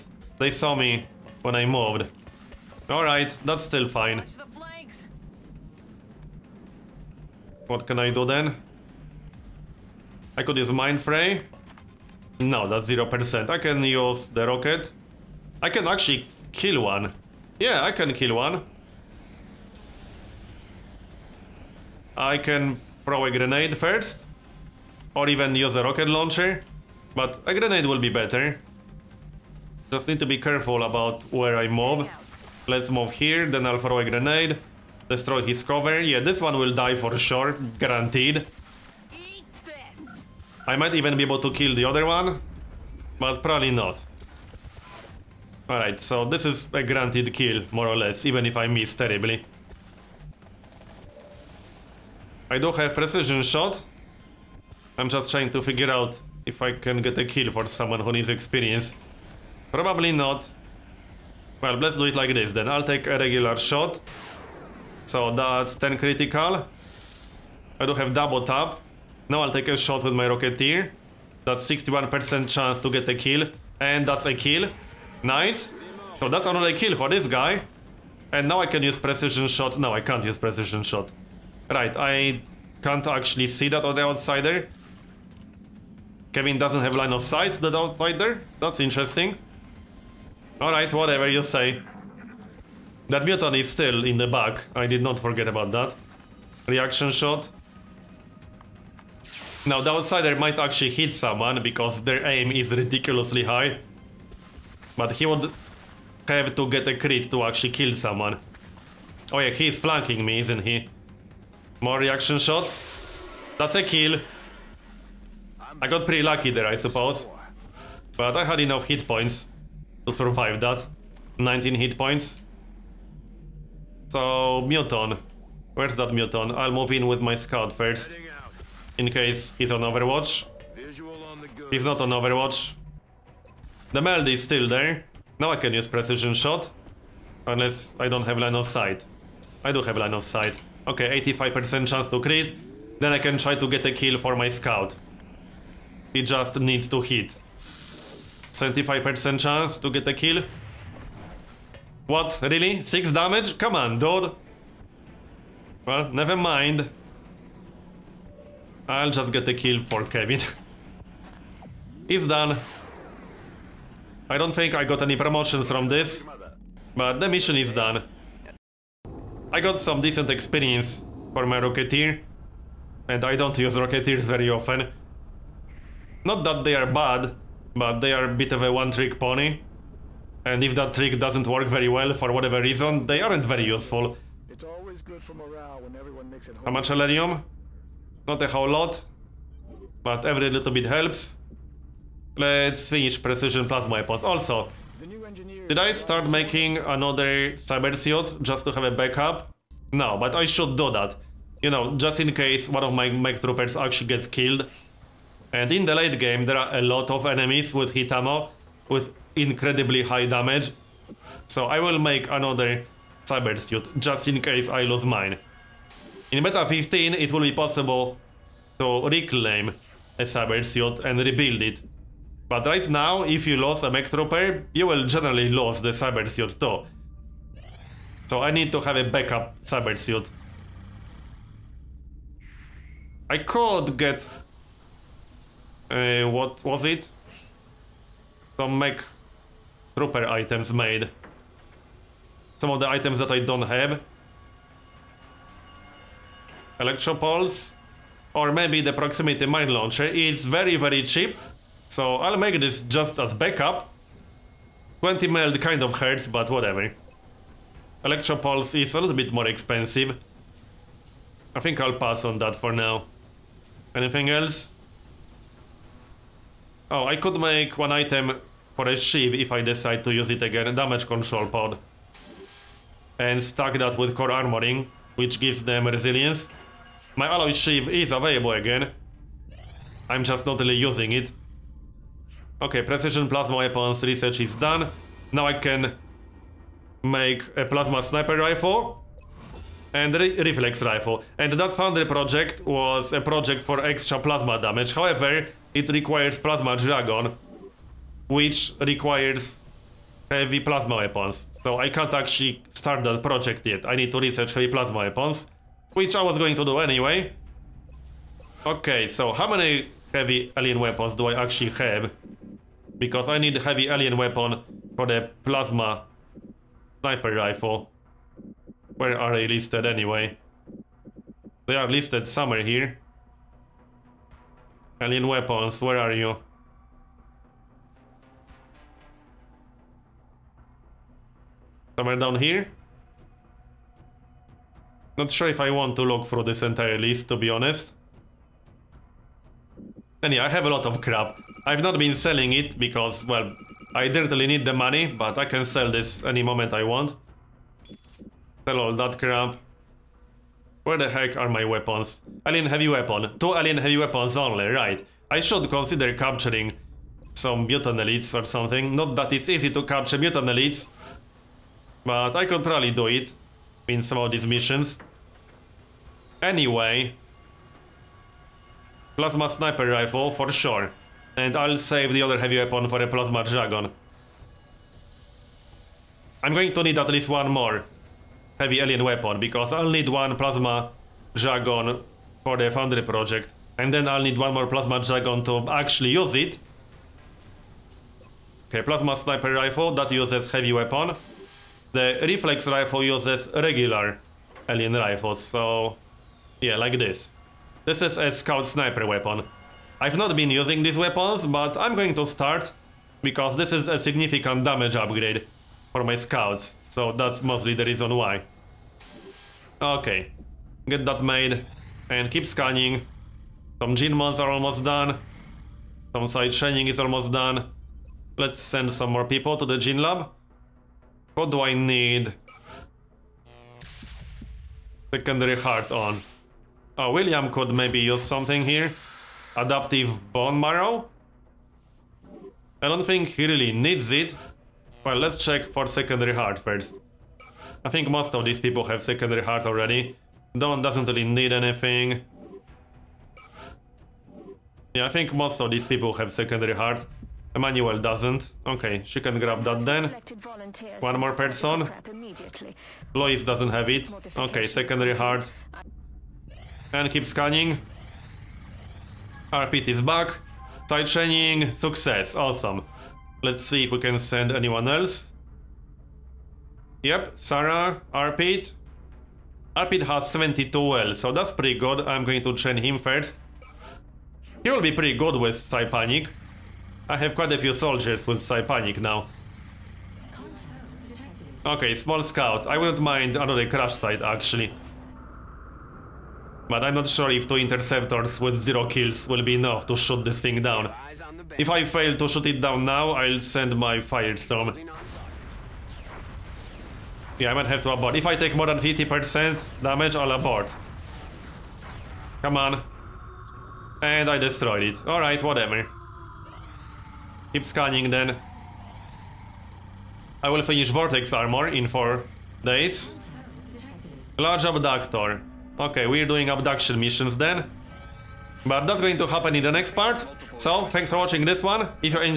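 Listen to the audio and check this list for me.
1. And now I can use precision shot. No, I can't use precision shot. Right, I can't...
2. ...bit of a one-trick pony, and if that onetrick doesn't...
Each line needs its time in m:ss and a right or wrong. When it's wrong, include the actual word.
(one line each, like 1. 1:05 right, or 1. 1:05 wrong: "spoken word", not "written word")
1. 1:18 right
2. 2:58 wrong: "trick", not "onetrick".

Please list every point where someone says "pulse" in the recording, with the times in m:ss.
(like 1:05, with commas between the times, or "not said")
4:07, 4:18.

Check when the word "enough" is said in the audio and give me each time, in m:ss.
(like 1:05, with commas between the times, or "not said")
1:58, 8:09.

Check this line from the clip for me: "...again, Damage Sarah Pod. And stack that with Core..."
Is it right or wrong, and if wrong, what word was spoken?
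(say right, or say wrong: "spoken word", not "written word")
wrong: "Control", not "Sarah".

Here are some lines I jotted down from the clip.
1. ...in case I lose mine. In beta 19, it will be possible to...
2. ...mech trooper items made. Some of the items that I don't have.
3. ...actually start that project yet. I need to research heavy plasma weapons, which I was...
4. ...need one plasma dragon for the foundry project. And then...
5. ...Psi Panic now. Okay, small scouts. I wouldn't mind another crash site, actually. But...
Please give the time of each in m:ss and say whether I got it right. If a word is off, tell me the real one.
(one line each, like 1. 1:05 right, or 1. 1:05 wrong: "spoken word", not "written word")
1. 3:34 wrong: "15", not "19"
2. 3:58 right
3. 5:02 right
4. 6:19 right
5. 7:58 right.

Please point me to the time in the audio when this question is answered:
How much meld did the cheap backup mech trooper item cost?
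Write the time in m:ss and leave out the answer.
4:15.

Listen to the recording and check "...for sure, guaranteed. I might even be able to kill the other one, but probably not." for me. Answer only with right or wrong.
right.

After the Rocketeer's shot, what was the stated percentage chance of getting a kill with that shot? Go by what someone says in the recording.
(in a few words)
61%.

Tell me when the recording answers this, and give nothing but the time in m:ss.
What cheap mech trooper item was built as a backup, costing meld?
4:08.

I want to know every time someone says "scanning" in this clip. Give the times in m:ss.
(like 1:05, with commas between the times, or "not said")
6:52, 7:37, 8:27.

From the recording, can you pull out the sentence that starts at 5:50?
Where the heck are my weapons?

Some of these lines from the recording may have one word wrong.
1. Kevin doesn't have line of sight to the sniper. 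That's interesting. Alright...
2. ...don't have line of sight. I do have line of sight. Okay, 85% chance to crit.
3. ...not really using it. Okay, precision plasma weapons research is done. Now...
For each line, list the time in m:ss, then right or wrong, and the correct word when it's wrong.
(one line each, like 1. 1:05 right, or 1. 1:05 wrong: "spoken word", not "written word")
1. 1:26 wrong: "outsider", not "sniper"
2. 2:18 right
3. 4:40 right.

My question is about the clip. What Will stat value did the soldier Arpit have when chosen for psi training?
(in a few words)
72.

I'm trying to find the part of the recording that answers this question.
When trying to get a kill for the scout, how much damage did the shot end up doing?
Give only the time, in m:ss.
2:32.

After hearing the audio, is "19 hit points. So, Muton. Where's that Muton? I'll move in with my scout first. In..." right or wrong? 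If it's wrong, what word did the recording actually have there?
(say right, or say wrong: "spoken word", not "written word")
right.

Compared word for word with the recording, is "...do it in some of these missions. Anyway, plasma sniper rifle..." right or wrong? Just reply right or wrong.
right.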